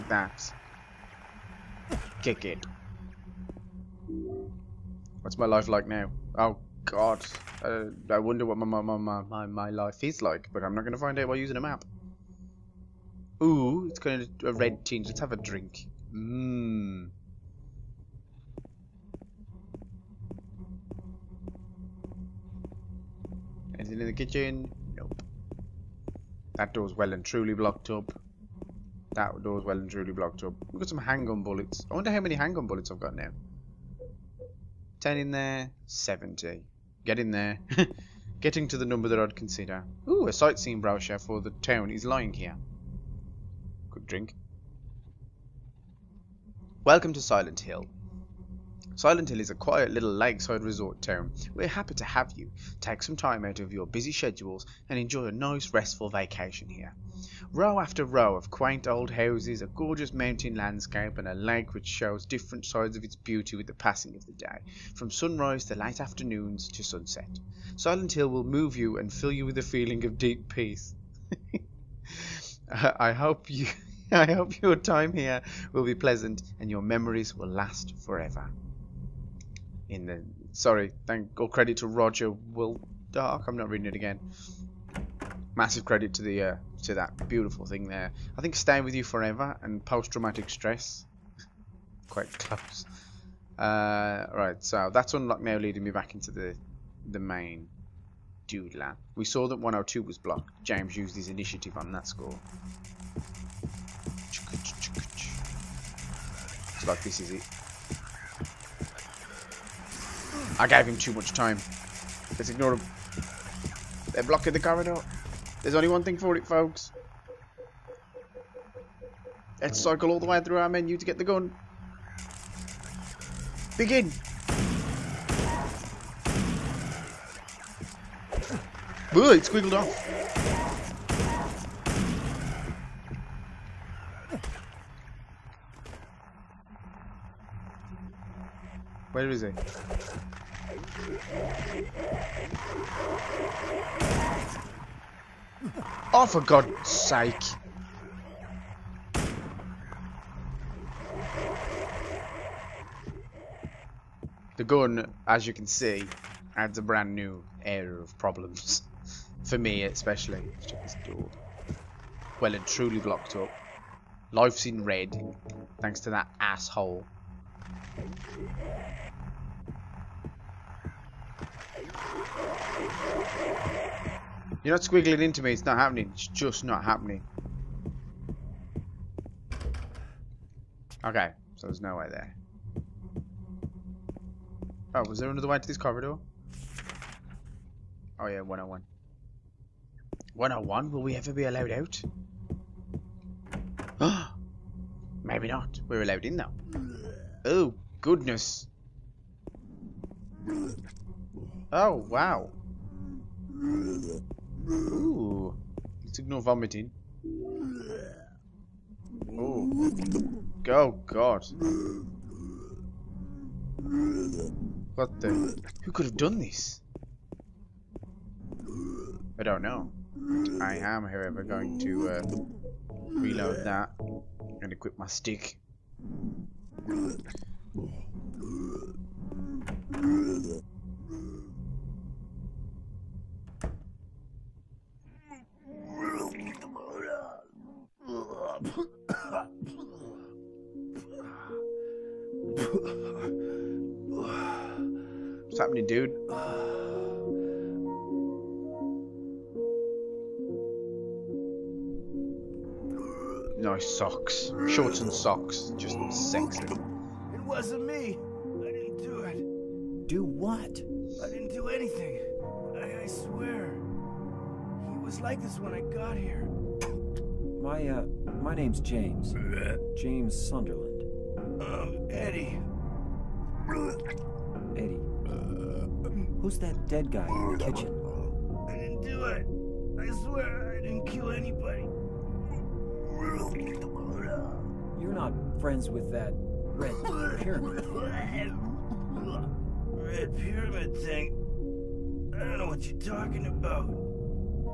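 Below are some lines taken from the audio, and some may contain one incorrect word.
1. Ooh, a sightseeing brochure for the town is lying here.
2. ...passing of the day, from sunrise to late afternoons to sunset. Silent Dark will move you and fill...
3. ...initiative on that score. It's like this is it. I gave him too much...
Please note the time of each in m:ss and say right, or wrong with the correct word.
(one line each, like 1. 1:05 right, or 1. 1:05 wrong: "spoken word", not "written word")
1. 0:40 right
2. 1:03 wrong: "Hill", not "Dark"
3. 1:41 right.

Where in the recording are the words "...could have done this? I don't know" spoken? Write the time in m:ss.
3:35.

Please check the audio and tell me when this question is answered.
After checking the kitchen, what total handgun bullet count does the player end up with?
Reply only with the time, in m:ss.
0:35.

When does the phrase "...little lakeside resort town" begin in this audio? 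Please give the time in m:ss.
0:49.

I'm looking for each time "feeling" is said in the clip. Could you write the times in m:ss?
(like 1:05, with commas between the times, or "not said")
1:09.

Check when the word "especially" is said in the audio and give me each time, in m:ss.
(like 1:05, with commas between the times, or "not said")
2:39.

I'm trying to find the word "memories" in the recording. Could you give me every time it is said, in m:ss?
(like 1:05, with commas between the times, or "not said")
1:16.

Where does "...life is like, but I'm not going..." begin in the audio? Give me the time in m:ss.
0:09.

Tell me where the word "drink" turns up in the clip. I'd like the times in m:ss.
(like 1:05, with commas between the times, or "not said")
0:15, 0:44.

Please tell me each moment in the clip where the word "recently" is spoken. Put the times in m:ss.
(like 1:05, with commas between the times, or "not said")
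not said.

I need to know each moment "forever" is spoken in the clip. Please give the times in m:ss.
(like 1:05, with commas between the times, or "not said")
1:17, 1:29.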